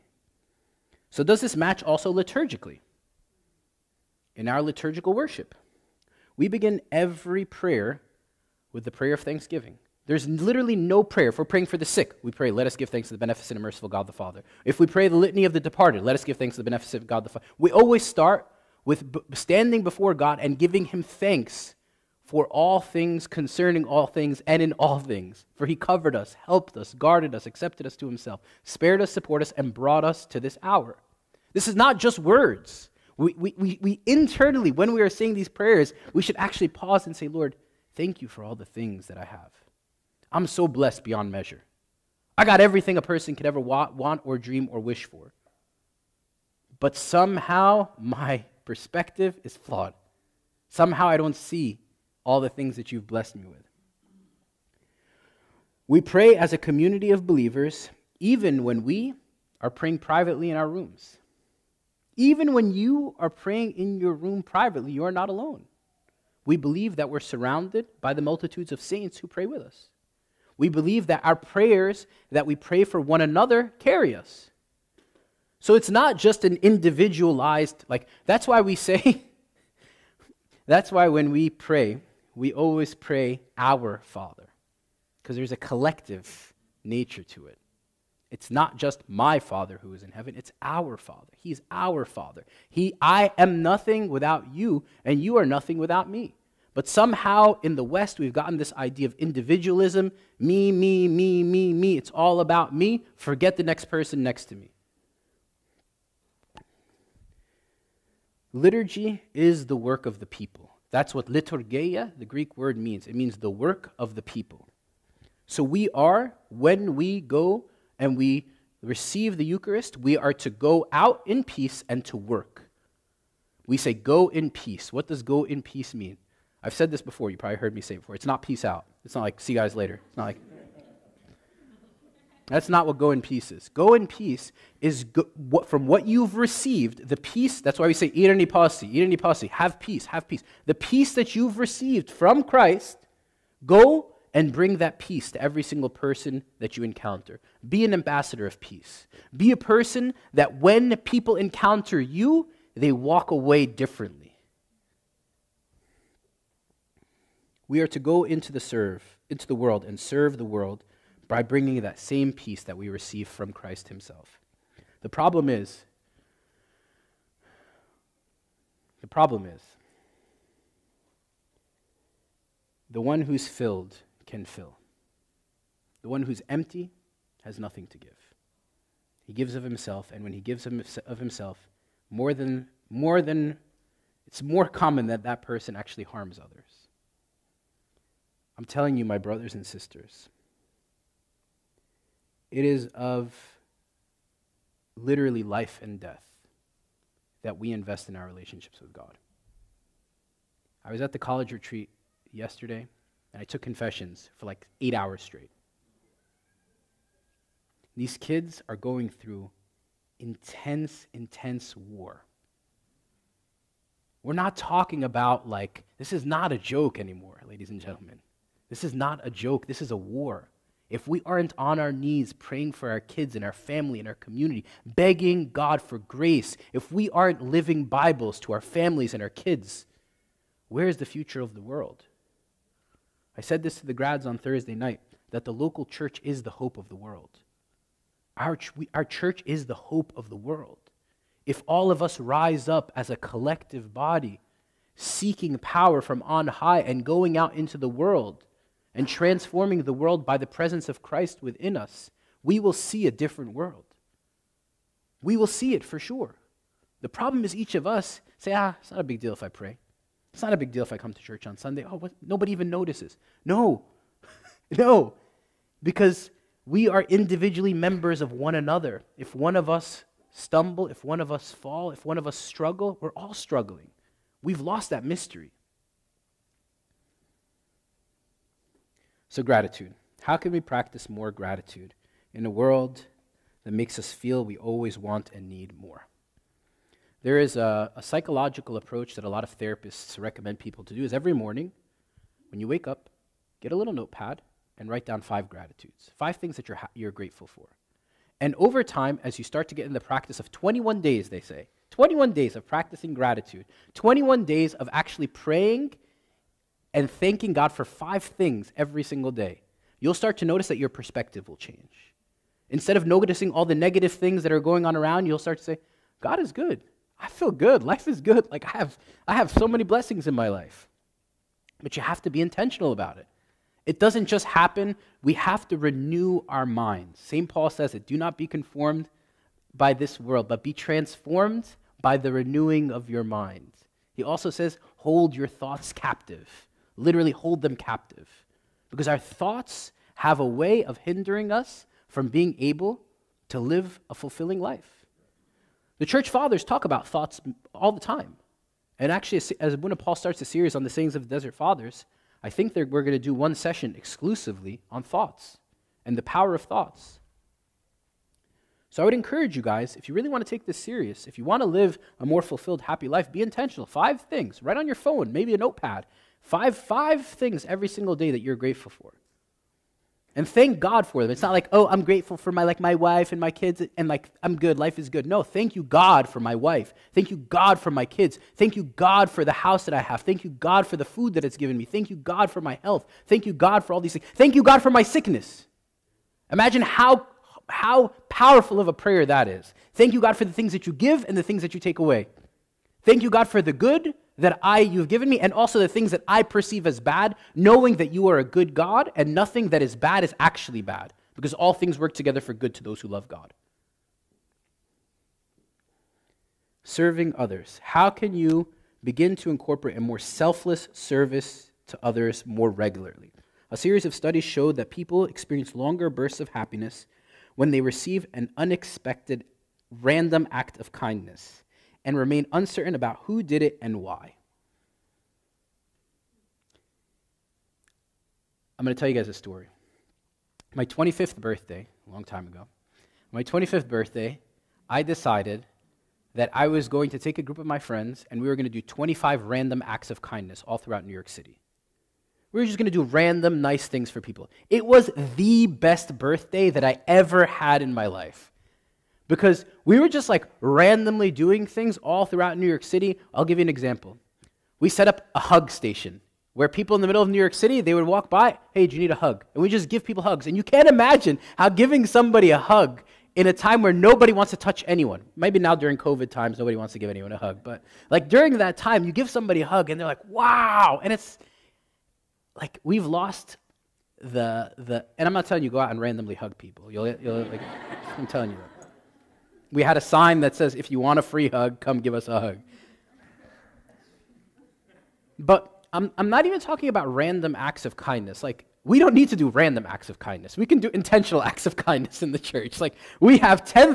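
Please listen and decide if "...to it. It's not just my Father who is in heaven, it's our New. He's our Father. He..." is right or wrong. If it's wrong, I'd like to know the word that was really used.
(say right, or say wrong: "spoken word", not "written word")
wrong: "Father", not "New".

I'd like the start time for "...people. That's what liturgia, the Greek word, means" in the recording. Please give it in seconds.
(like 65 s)
110 s.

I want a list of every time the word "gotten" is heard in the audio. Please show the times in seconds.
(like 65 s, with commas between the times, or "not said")
98 s.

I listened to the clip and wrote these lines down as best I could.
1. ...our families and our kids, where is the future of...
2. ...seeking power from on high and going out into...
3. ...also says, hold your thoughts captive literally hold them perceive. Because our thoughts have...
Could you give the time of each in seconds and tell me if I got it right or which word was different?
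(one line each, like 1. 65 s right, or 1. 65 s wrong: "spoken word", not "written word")
1. 228 s right
2. 244 s right
3. 334 s wrong: "captive", not "perceive".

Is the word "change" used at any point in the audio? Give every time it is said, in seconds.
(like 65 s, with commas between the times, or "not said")
311 s.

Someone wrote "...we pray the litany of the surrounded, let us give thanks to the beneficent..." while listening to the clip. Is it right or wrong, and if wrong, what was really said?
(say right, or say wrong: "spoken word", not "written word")
wrong: "departed", not "surrounded".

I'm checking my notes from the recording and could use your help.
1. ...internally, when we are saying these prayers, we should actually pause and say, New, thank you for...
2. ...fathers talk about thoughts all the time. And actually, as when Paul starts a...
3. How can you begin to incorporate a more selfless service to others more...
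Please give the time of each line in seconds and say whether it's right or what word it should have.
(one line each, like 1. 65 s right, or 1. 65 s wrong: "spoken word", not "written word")
1. 34 s wrong: "Lord", not "New"
2. 346 s right
3. 407 s right.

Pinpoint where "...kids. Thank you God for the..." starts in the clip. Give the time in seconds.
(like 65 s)
378 s.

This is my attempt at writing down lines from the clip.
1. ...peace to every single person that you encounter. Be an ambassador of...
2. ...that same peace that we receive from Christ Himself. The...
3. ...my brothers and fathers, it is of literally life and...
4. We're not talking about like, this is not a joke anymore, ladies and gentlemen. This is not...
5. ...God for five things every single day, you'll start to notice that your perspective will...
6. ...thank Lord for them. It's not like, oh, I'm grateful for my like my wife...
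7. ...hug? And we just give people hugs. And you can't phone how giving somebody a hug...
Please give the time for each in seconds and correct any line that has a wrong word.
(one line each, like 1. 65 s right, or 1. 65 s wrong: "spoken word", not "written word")
1. 144 s right
2. 161 s right
3. 189 s wrong: "sisters", not "fathers"
4. 214 s right
5. 307 s right
6. 370 s wrong: "God", not "Lord"
7. 459 s wrong: "imagine", not "phone".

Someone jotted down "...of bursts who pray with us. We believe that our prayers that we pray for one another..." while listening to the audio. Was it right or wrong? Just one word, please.
wrong.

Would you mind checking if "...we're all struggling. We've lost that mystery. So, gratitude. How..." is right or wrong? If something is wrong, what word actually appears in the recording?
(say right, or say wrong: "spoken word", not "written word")
right.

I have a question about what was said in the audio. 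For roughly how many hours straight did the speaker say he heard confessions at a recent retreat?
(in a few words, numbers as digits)
8.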